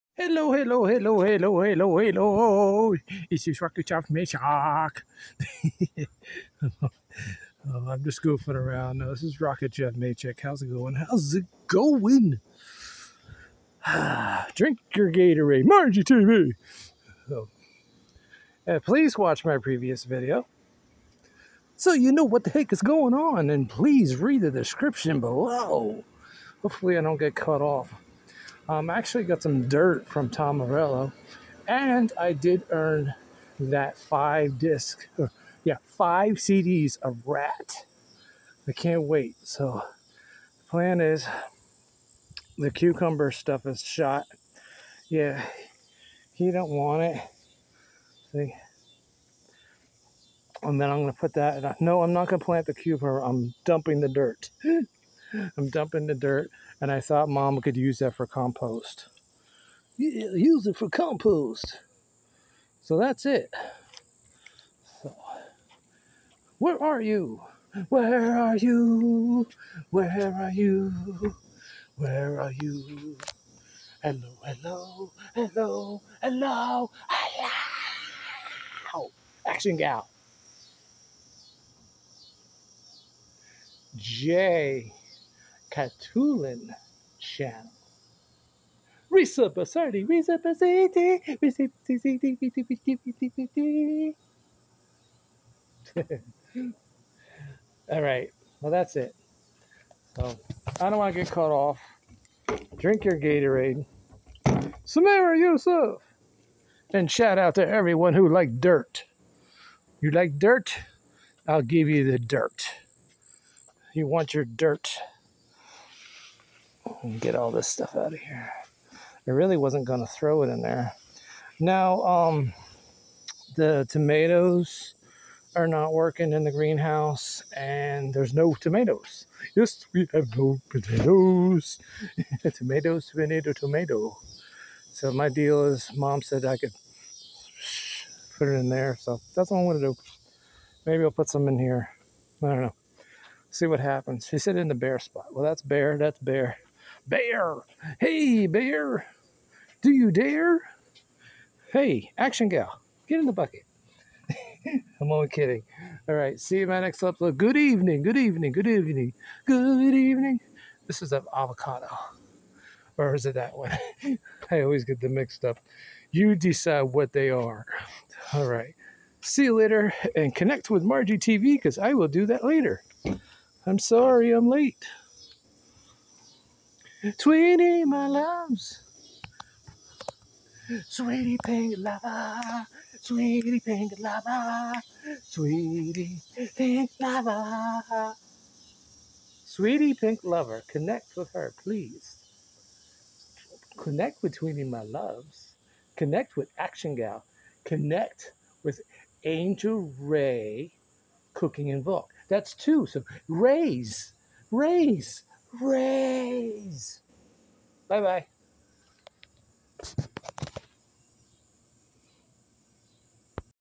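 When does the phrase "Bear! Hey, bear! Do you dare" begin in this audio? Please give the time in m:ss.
2:27.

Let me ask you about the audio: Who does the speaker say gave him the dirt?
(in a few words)
Tom Morello.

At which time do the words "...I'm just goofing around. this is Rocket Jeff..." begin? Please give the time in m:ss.
0:07.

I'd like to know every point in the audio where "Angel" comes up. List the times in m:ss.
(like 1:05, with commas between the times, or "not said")
3:19.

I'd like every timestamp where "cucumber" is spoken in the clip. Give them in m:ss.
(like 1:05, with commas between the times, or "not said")
0:42, 0:52.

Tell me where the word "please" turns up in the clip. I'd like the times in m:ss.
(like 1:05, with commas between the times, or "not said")
0:18, 0:23, 3:11.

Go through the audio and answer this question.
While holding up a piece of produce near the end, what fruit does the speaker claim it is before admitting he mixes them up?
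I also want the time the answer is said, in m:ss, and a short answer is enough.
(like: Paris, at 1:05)
avocado, at 2:41.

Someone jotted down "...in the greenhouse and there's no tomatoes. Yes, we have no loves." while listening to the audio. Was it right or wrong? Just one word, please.
wrong.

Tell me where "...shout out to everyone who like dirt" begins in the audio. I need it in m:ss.
1:47.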